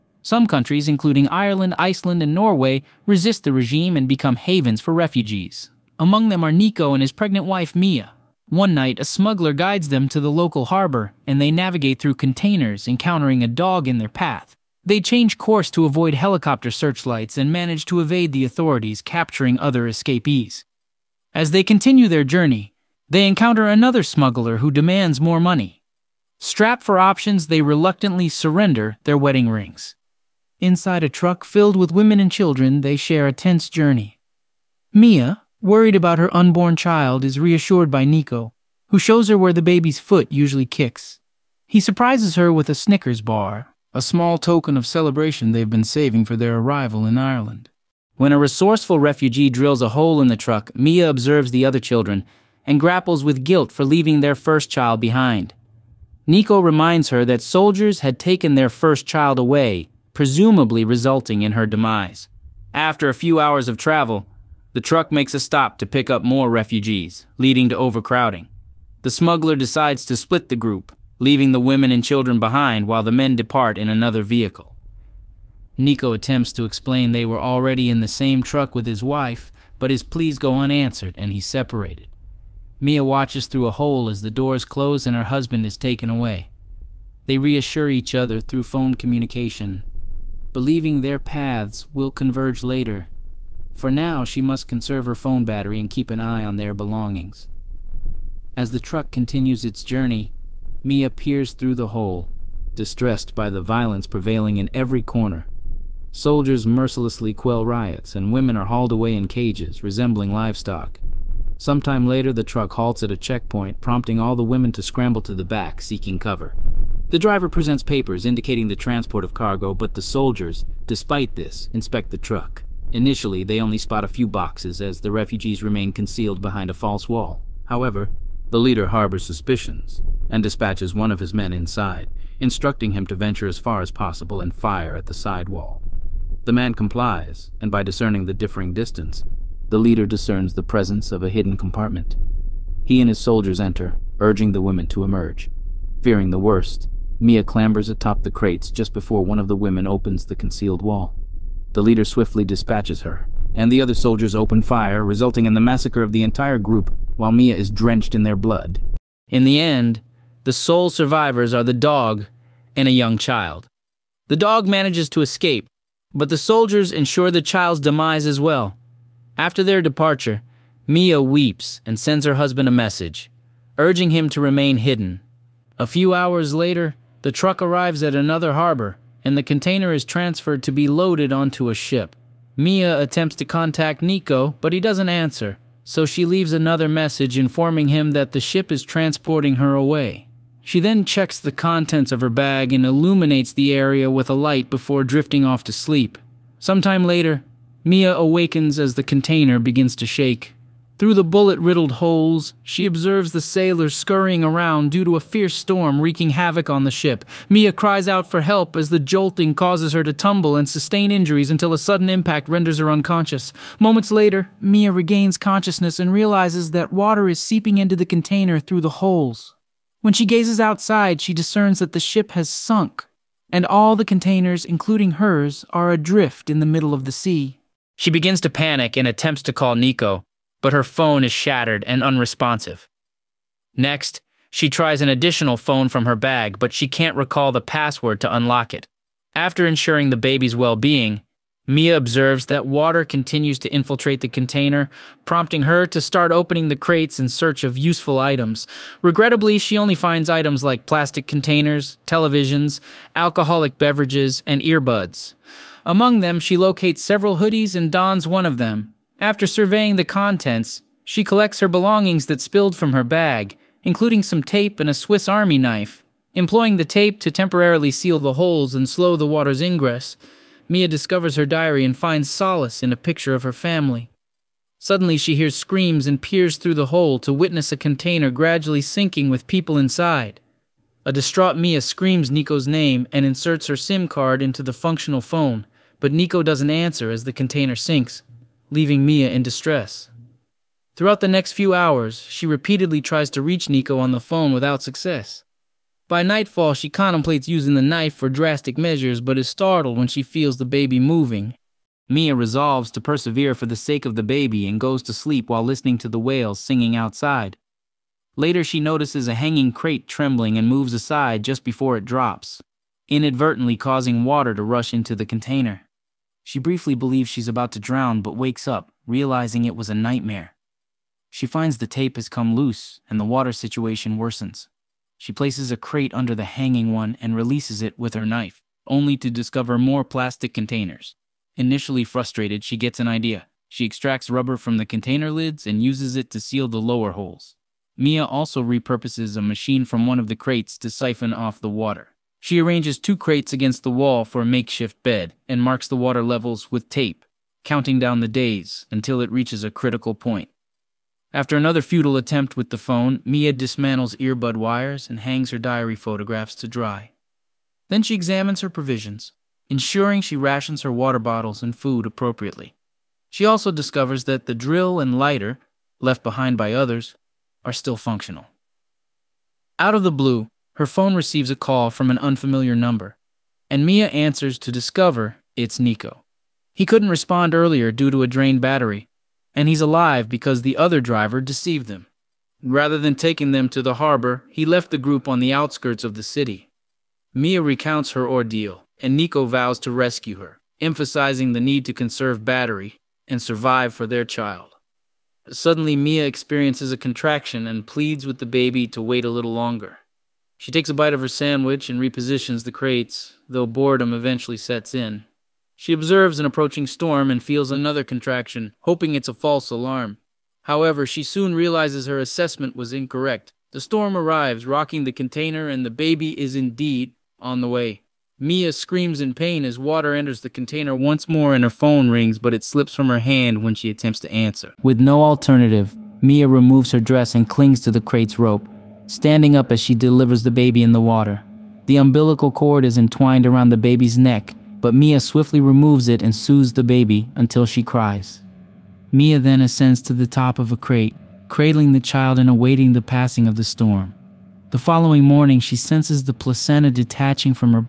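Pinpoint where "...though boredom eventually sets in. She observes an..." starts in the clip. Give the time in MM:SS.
06:43.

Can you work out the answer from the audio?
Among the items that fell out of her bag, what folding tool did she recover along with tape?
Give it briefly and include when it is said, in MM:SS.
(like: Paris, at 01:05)
Swiss Army knife, at 04:24.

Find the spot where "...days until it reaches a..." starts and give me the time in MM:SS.
05:48.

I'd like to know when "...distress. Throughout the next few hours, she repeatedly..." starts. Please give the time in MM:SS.
04:49.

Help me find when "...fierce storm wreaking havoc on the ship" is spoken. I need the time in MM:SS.
03:25.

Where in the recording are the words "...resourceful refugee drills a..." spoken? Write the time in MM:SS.
00:48.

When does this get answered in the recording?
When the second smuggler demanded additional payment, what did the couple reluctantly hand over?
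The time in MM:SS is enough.
00:29.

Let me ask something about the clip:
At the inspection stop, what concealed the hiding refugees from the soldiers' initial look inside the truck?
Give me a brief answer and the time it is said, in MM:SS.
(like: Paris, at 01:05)
False wall, at 02:06.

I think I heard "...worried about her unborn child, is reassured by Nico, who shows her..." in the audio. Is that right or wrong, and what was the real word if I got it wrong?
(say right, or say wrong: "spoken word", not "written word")
right.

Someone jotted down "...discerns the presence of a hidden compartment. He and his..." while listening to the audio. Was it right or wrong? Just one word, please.
right.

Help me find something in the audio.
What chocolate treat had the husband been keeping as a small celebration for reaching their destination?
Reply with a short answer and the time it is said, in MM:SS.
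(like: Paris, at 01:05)
Snickers bar, at 00:42.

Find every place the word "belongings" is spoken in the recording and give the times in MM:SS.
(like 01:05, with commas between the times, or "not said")
01:36, 04:21.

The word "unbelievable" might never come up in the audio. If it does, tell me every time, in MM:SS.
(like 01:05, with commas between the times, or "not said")
not said.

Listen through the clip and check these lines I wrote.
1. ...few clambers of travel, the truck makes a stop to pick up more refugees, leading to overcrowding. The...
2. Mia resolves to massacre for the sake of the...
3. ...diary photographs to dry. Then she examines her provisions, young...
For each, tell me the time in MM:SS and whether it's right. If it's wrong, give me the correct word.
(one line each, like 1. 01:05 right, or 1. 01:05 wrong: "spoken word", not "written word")
1. 01:03 wrong: "hours", not "clambers"
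2. 05:02 wrong: "persevere", not "massacre"
3. 05:55 wrong: "ensuring", not "young".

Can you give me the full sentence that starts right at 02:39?
In the end, the sole survivors are the dog and a young child.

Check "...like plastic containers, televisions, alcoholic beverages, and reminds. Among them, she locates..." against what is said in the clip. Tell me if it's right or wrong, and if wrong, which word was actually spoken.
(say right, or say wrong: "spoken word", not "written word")
wrong: "earbuds", not "reminds".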